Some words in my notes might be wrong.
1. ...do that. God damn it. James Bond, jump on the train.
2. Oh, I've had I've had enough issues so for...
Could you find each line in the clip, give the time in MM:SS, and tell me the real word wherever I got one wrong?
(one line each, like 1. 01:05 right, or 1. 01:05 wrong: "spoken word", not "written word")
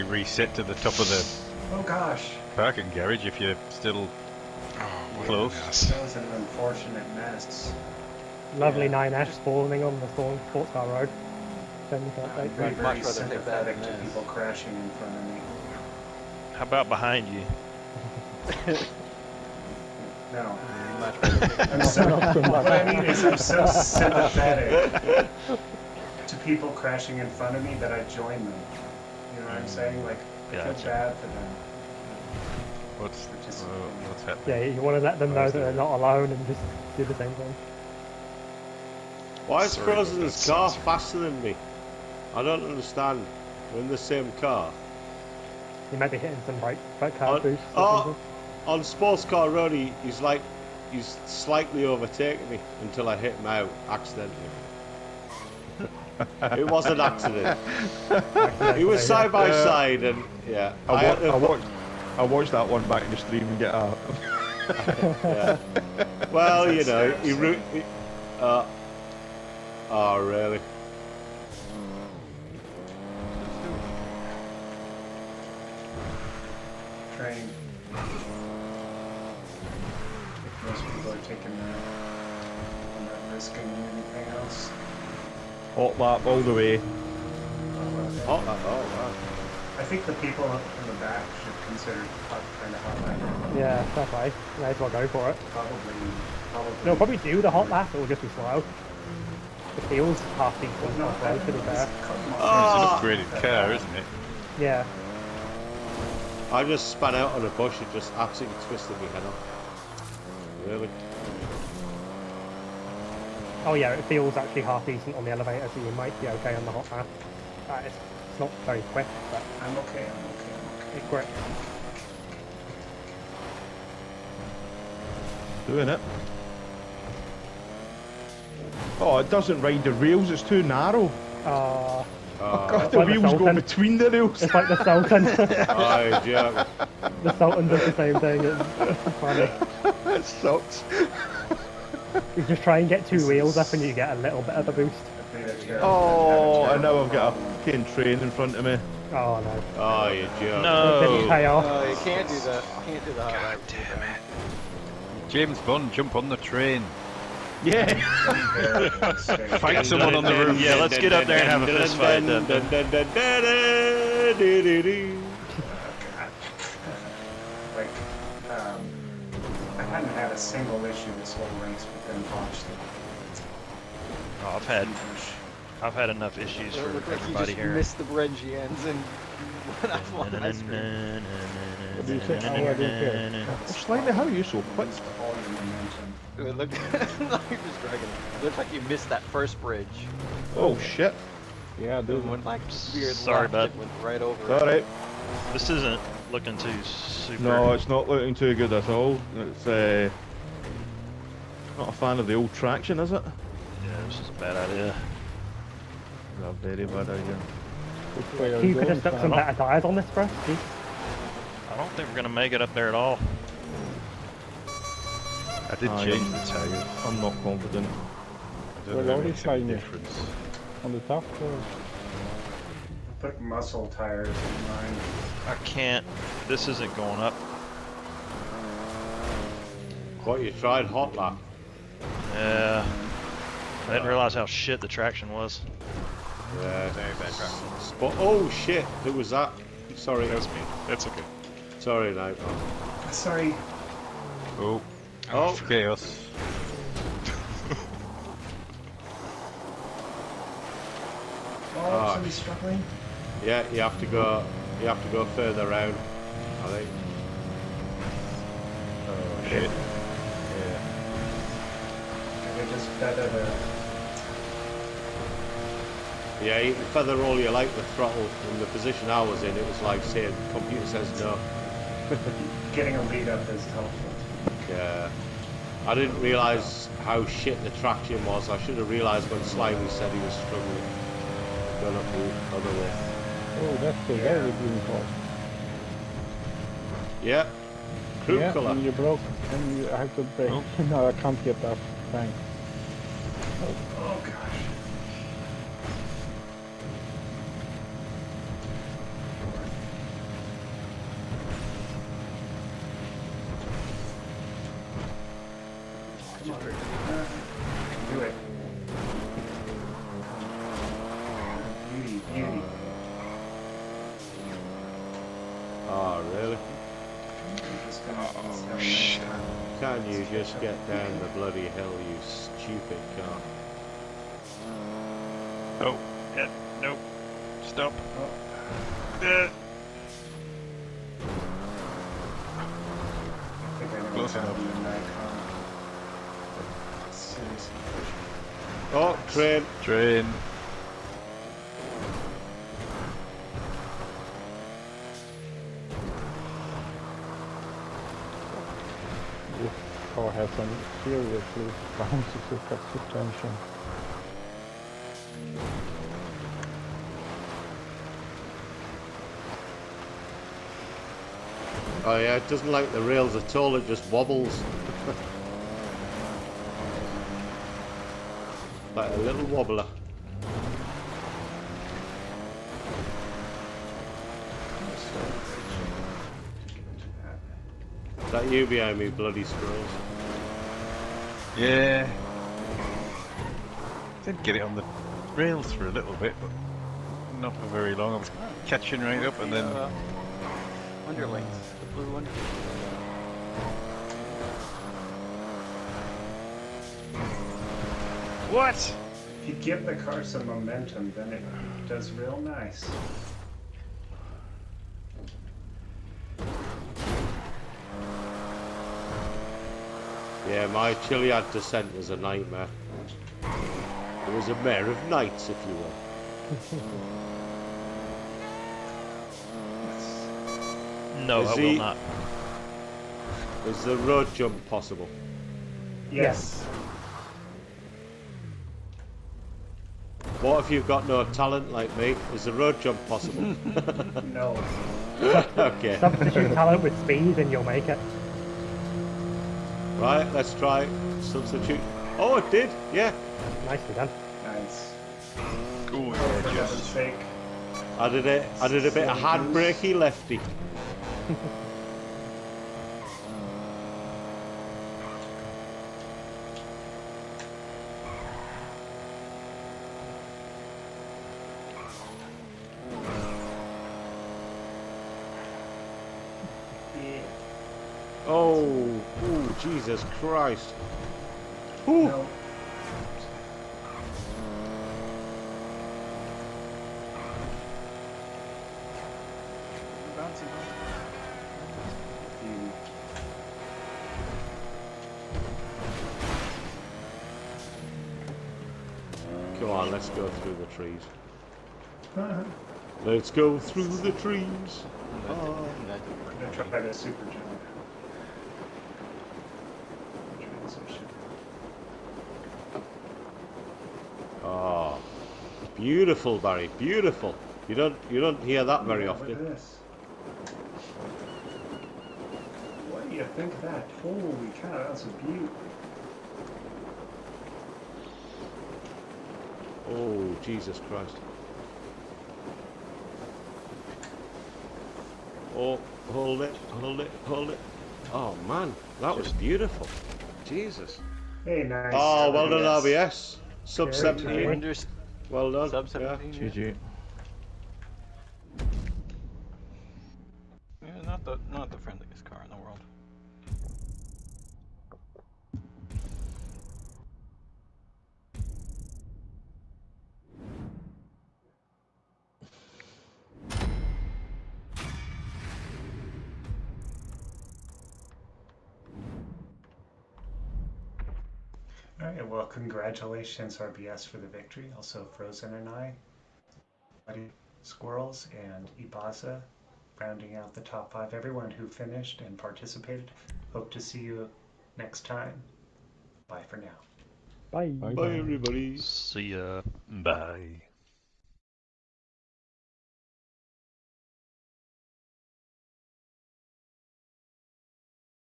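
1. 02:33 right
2. 02:54 right.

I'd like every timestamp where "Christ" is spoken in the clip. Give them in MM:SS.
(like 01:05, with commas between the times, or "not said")
07:50, 08:40.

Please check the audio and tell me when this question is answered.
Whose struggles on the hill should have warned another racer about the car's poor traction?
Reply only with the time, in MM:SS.
04:39.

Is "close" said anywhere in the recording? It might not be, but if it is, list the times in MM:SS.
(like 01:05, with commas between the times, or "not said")
00:05, 05:34.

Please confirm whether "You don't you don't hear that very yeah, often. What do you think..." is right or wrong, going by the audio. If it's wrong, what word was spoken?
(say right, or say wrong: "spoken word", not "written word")
right.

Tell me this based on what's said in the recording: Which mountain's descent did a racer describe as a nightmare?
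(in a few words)
Chiliad.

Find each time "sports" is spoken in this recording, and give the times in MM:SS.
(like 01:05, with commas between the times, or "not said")
00:10, 00:48.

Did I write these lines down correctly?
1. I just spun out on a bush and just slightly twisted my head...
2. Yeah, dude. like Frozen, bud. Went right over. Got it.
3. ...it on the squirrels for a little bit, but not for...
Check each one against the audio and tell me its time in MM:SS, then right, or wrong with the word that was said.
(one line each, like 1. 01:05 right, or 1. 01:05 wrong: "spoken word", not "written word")
1. 01:46 wrong: "absolutely", not "slightly"
2. 03:11 wrong: "Sorry", not "Frozen"
3. 06:24 wrong: "rails", not "squirrels".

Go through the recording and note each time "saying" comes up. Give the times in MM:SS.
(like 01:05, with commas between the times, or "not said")
00:29, 04:30.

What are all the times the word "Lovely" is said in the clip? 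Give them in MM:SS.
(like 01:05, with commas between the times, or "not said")
00:08.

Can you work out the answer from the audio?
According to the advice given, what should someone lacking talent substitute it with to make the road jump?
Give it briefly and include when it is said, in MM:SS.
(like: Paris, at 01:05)
Speed, at 07:17.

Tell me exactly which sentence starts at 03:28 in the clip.
you could have stuck some better tires on this, bro.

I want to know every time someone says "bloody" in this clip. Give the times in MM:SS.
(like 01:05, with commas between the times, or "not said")
05:21, 06:19.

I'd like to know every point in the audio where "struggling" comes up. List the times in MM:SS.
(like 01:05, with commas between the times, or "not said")
04:12, 04:40.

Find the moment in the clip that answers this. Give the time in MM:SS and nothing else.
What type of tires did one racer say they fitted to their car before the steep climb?
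03:43.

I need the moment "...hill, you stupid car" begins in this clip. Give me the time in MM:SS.
05:21.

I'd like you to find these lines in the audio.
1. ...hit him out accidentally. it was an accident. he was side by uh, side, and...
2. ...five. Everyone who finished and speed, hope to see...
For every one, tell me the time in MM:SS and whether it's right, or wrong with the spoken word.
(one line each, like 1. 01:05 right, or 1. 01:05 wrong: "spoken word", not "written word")
1. 00:53 right
2. 09:30 wrong: "participated", not "speed".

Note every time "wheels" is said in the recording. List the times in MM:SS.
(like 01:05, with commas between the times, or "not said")
02:13, 02:23.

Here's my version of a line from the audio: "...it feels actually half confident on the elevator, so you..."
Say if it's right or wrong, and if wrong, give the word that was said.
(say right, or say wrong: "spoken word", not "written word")
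wrong: "decent", not "confident".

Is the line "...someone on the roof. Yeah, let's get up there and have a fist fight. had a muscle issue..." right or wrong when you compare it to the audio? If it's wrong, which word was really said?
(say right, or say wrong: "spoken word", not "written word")
wrong: "single", not "muscle".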